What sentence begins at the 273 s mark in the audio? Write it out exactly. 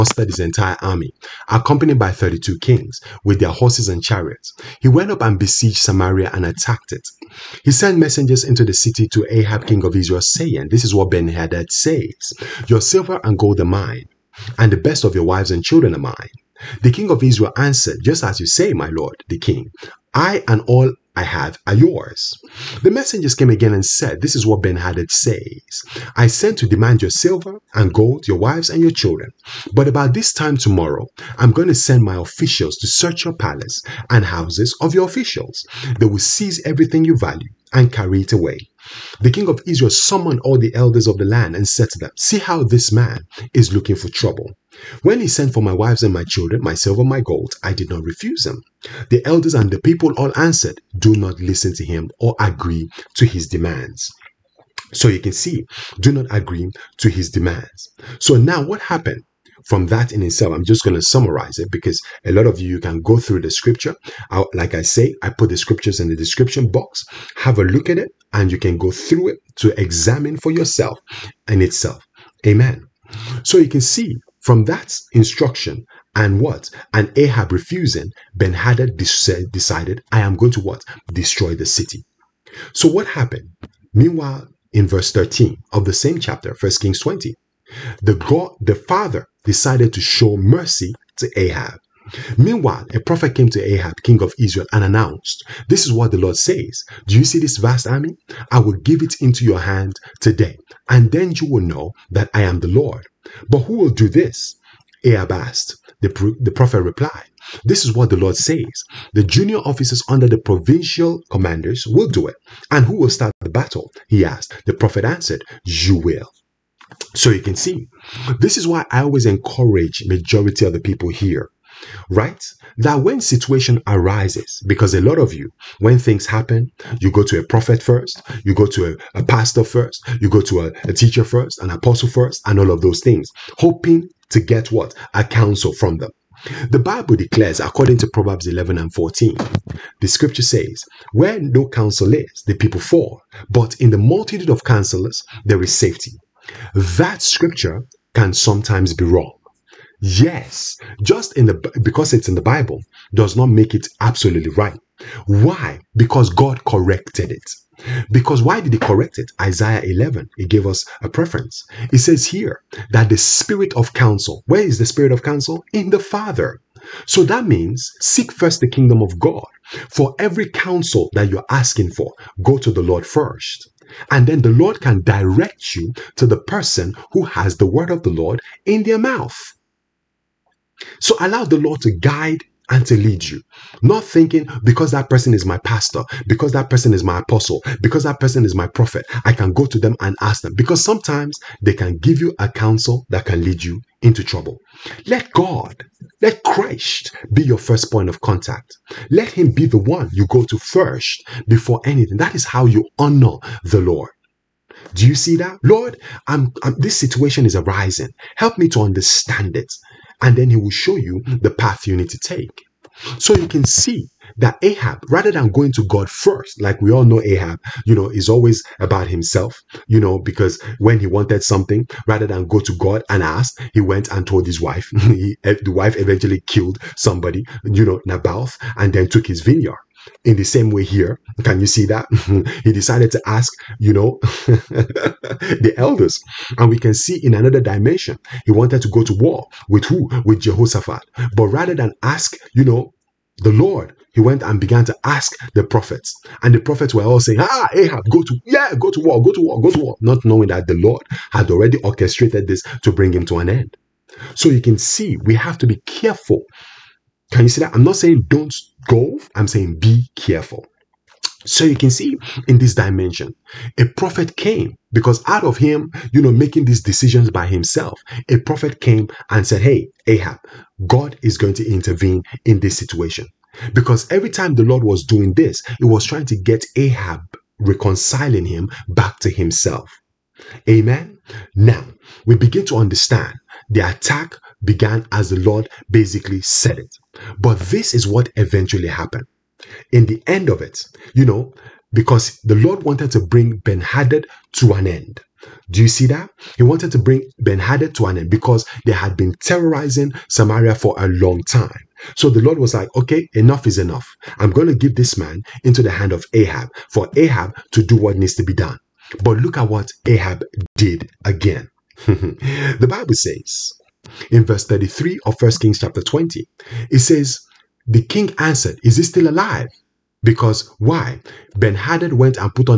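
Because every time the Lord was doing this, He was trying to get Ahab reconciling him back to himself.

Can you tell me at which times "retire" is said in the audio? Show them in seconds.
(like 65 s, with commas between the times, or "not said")
not said.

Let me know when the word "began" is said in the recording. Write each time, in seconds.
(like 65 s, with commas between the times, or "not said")
244 s, 284 s.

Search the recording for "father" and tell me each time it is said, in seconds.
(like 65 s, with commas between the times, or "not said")
88 s, 165 s.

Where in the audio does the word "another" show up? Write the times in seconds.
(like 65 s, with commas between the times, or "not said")
237 s.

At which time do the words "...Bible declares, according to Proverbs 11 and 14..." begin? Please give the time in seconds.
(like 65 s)
136 s.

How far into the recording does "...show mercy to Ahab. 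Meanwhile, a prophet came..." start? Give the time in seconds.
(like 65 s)
90 s.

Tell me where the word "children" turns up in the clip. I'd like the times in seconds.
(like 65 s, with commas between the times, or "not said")
15 s, 28 s, 46 s.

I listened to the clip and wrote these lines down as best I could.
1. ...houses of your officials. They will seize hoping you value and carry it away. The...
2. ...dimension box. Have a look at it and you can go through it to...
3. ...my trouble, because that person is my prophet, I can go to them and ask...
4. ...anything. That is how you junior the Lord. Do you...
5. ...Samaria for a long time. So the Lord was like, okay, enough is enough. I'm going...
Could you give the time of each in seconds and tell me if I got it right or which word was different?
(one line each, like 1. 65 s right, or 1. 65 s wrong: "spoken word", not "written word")
1. 34 s wrong: "everything", not "hoping"
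2. 66 s wrong: "description", not "dimension"
3. 187 s wrong: "apostle", not "trouble"
4. 201 s wrong: "honor", not "junior"
5. 300 s right.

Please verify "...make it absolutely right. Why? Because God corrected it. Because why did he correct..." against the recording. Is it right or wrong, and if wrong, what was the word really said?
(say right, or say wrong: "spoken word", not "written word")
right.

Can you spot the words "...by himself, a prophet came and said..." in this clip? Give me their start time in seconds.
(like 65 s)
267 s.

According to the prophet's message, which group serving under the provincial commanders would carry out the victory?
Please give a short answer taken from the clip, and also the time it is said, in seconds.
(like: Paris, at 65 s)
junior officers, at 109 s.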